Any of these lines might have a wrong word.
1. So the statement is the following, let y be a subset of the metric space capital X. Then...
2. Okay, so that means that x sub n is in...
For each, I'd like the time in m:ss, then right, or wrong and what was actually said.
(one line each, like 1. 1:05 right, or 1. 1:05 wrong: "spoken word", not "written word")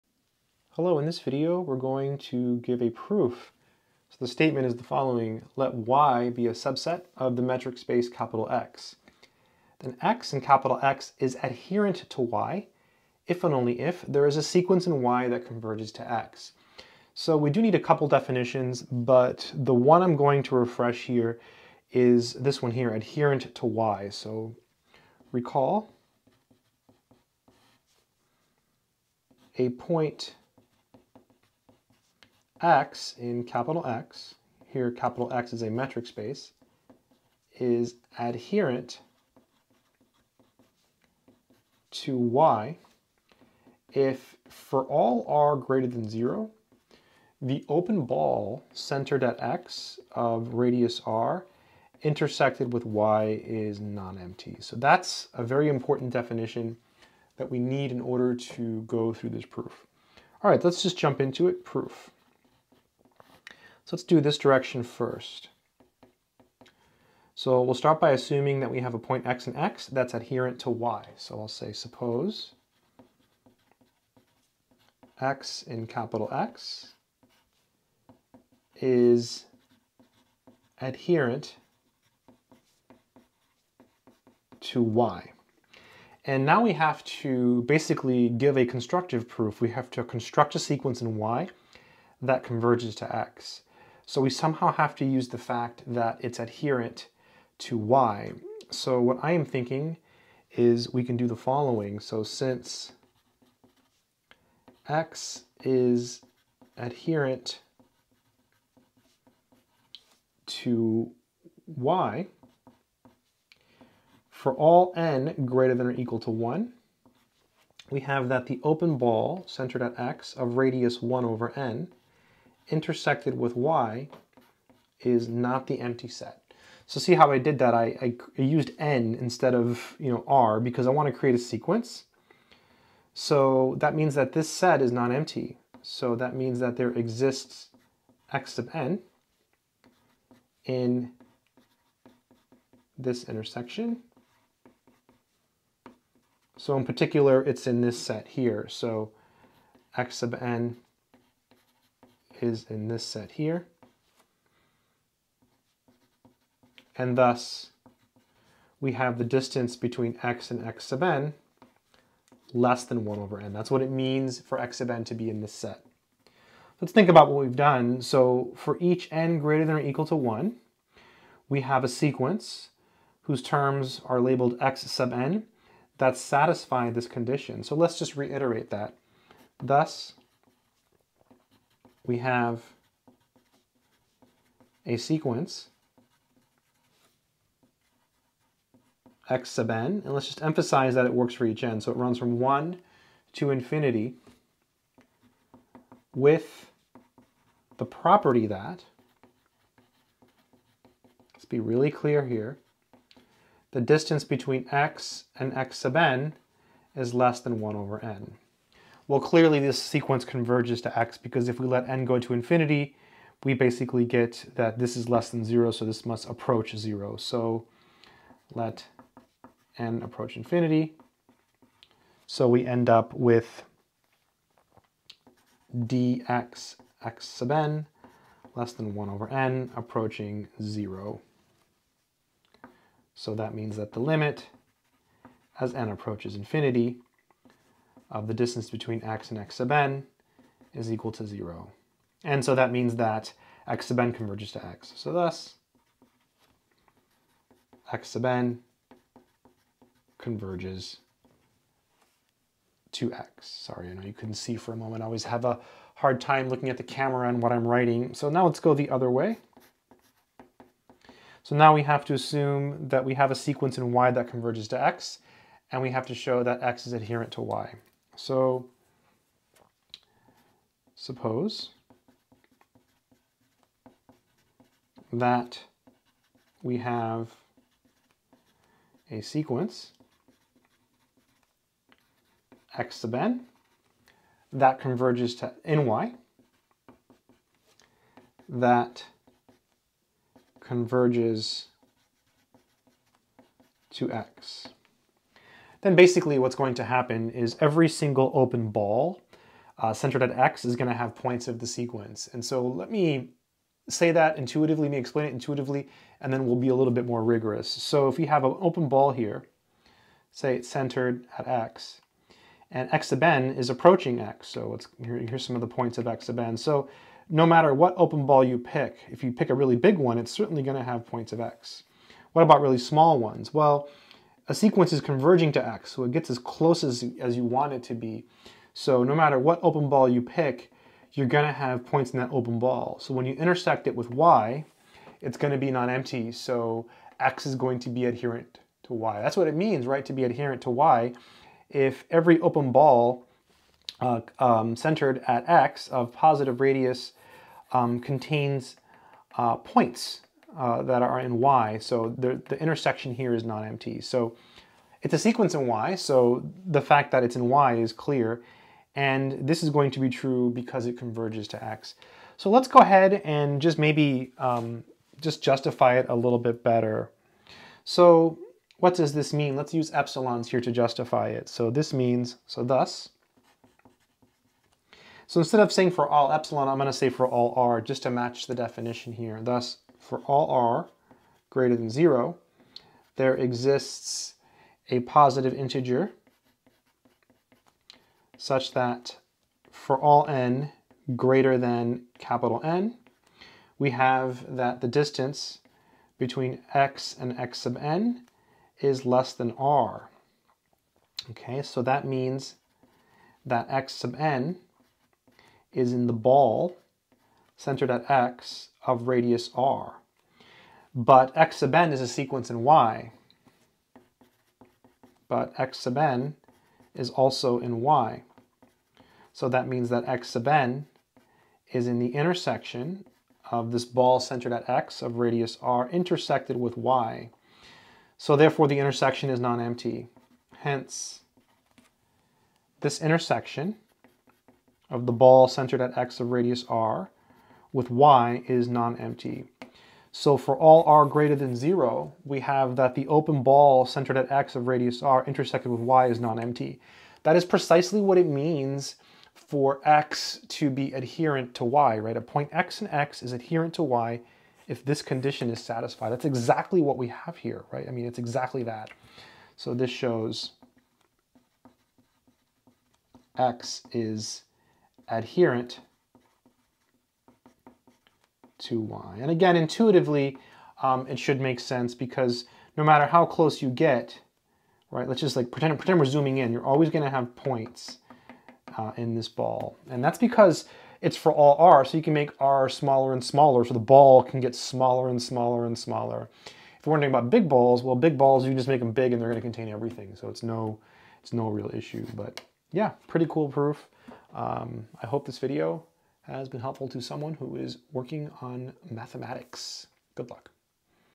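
1. 0:04 right
2. 6:41 right.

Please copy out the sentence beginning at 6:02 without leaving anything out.
So let's go ahead and just maybe um, just justify it a little bit better.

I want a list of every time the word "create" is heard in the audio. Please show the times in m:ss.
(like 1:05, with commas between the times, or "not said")
2:11.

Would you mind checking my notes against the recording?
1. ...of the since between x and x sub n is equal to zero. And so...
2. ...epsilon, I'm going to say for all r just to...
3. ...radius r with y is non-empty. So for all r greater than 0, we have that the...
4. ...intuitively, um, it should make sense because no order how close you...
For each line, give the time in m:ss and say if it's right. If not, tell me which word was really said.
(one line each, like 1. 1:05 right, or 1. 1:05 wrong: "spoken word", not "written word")
1. 3:58 wrong: "distance", not "since"
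2. 6:16 right
3. 7:16 right
4. 7:49 wrong: "matter", not "order".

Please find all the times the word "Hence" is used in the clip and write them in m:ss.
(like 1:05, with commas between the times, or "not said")
7:10.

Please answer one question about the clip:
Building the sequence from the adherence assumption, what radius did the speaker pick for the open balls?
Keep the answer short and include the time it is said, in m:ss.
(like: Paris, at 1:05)
1 over n, at 2:00.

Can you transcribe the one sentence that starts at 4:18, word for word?
So now let's go the other way.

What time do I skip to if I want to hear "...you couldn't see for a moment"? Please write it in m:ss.
4:14.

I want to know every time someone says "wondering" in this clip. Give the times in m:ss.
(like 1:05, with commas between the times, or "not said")
8:06.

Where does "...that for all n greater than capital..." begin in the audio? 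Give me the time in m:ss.
6:28.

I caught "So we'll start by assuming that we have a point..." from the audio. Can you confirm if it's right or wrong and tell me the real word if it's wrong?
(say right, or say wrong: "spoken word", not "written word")
right.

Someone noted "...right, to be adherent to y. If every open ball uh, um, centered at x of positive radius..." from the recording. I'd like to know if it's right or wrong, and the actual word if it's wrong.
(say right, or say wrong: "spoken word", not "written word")
right.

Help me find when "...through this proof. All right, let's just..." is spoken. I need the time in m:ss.
0:59.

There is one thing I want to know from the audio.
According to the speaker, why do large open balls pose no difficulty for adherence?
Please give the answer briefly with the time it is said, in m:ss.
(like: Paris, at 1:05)
contain everything, at 8:09.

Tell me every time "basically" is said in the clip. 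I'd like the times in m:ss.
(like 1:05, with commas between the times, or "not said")
1:27, 3:33, 4:55.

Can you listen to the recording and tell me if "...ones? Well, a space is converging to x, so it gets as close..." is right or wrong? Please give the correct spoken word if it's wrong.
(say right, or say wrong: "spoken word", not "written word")
wrong: "sequence", not "space".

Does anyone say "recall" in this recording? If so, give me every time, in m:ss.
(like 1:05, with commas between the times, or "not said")
0:25.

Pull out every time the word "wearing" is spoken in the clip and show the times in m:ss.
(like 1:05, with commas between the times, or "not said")
not said.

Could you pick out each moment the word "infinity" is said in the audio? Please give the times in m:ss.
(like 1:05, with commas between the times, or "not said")
3:13, 3:32, 3:40, 3:56.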